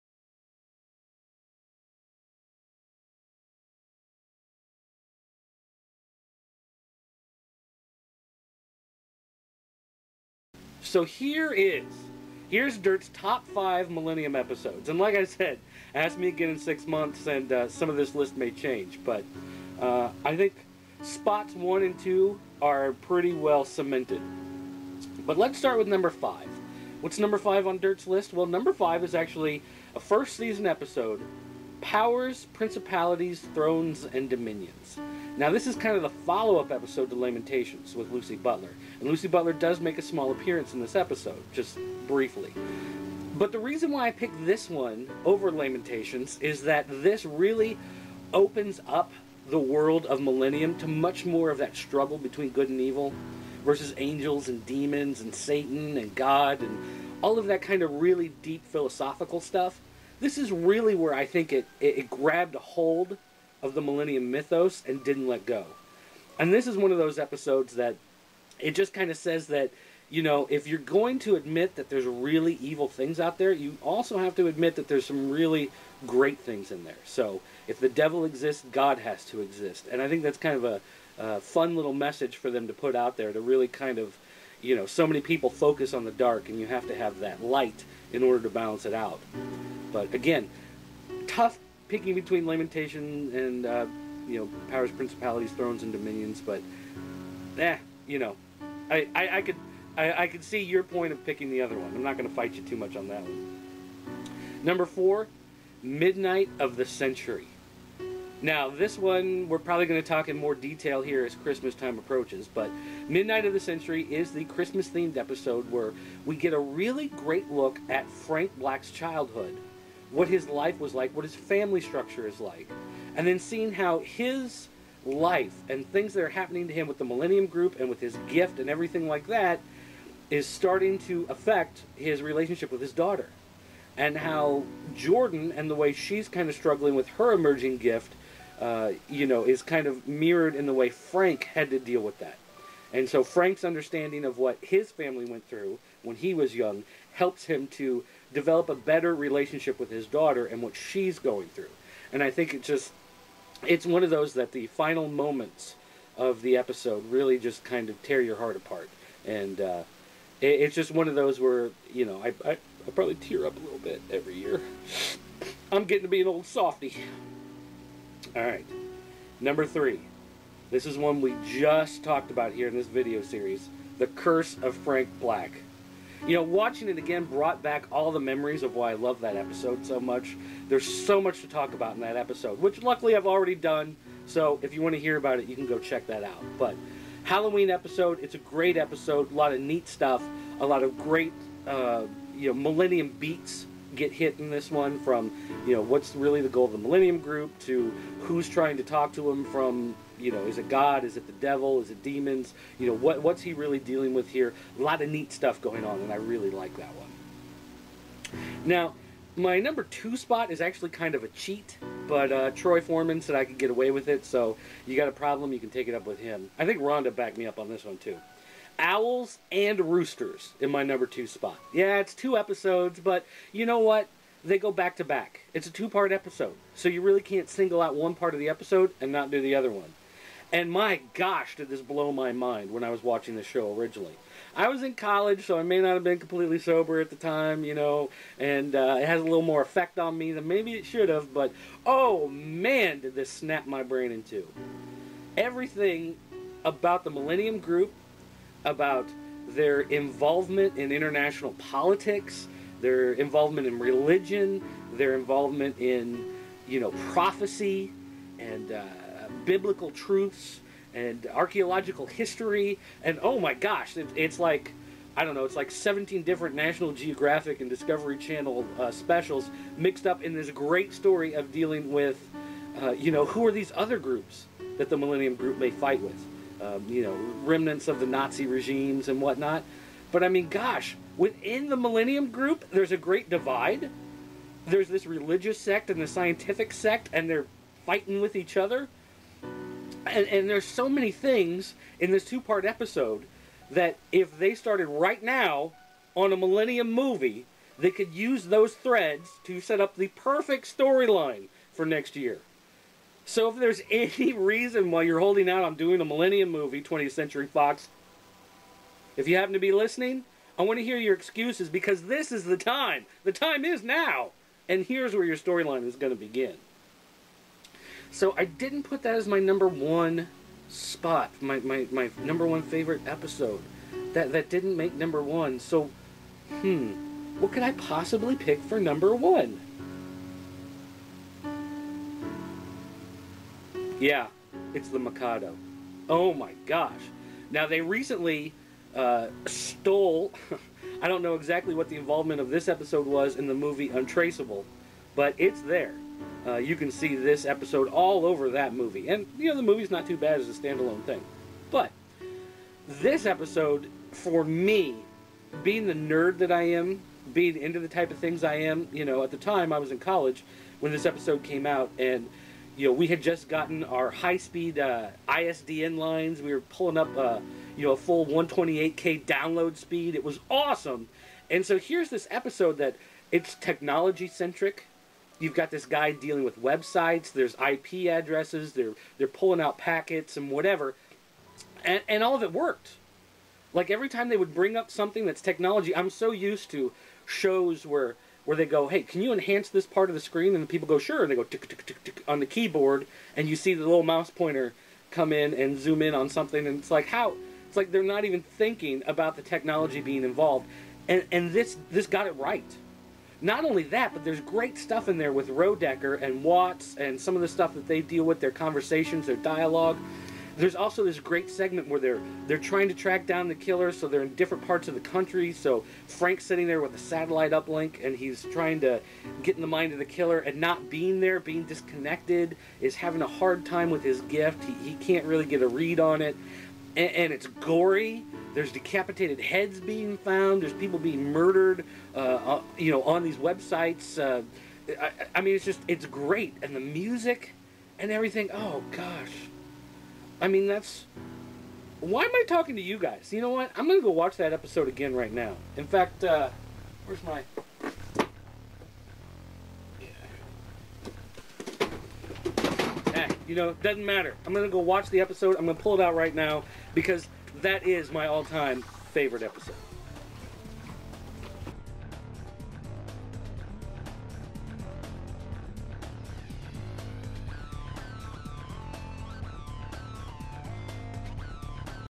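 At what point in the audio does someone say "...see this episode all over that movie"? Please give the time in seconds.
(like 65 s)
346 s.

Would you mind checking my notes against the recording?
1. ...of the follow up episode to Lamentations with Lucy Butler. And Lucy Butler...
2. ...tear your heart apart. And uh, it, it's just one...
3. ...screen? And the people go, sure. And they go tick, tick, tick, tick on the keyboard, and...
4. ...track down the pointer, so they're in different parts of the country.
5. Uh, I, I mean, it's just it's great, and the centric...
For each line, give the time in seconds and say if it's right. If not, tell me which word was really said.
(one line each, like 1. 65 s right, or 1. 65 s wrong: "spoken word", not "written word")
1. 35 s right
2. 158 s right
3. 390 s right
4. 412 s wrong: "killer", not "pointer"
5. 434 s wrong: "music", not "centric".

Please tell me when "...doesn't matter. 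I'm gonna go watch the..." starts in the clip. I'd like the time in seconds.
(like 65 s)
453 s.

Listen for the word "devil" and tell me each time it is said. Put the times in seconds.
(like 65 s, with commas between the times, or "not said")
77 s, 201 s.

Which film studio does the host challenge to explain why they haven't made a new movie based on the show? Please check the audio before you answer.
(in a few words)
20th Century Fox.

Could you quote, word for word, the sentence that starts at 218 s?
Owls and Roosters in my number two spot.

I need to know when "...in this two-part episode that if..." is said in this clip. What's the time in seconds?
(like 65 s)
291 s.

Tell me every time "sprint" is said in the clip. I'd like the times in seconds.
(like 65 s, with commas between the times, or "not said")
not said.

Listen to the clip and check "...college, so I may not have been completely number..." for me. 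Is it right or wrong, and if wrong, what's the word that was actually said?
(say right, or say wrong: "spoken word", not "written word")
wrong: "sober", not "number".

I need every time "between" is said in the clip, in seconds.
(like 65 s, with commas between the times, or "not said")
52 s, 92 s.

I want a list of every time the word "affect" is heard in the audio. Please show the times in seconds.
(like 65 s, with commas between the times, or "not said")
131 s.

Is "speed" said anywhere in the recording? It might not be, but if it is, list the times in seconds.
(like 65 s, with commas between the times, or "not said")
364 s, 369 s.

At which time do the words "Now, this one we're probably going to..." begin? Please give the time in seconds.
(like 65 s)
108 s.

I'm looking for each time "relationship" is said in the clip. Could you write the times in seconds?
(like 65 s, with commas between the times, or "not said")
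132 s, 149 s.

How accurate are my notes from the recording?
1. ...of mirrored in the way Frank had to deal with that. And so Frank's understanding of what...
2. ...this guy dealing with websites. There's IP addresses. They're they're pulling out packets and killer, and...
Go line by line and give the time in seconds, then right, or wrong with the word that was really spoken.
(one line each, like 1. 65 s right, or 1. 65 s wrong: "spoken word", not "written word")
1. 139 s right
2. 375 s wrong: "whatever", not "killer".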